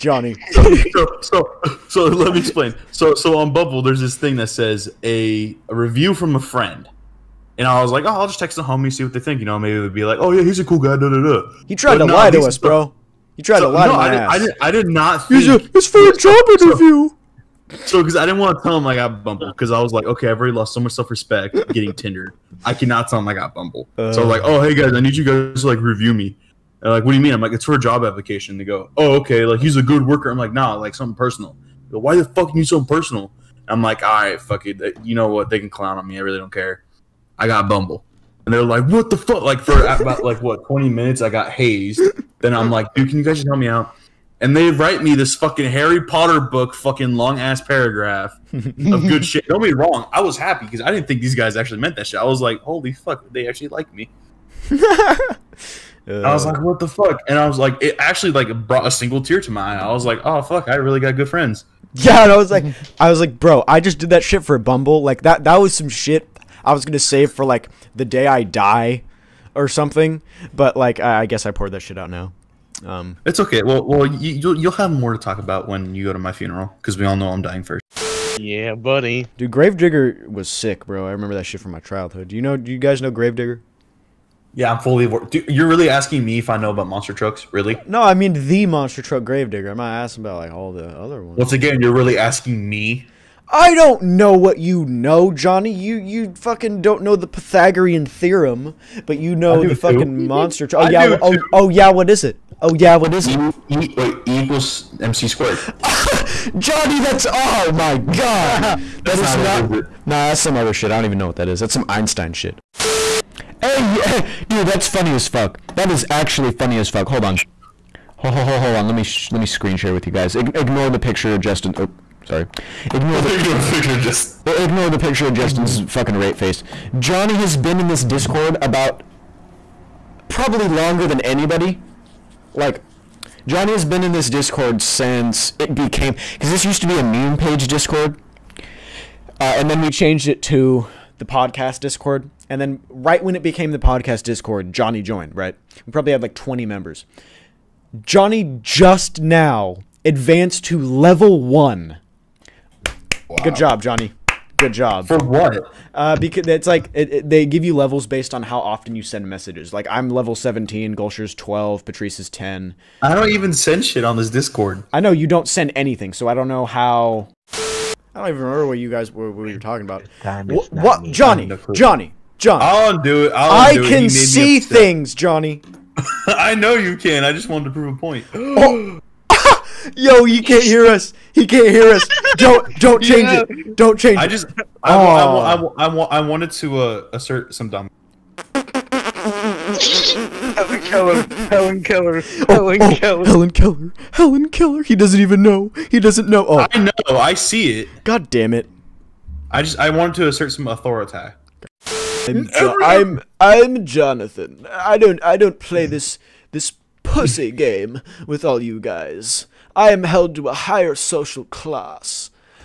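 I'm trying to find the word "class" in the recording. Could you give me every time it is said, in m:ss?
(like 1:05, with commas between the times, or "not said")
3:31.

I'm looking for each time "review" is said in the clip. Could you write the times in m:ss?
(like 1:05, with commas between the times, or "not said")
0:05, 0:25.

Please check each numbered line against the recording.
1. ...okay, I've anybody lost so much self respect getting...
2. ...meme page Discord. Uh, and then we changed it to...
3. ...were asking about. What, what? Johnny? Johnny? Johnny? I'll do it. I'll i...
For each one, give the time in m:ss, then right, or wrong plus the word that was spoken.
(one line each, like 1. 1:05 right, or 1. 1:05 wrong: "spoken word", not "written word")
1. 0:20 wrong: "already", not "anybody"
2. 2:17 right
3. 2:49 wrong: "talking", not "asking".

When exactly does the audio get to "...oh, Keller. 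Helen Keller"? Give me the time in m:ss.
3:12.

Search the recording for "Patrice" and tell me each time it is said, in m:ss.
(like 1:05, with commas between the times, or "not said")
2:41.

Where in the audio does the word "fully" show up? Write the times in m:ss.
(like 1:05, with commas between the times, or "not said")
1:24.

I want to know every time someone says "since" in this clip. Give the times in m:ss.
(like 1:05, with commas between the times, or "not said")
2:14.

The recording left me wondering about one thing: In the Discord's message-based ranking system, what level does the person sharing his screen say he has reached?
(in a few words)
17.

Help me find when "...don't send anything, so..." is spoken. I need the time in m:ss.
2:45.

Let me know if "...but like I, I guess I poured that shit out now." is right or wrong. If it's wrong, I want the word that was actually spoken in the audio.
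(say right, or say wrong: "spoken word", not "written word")
right.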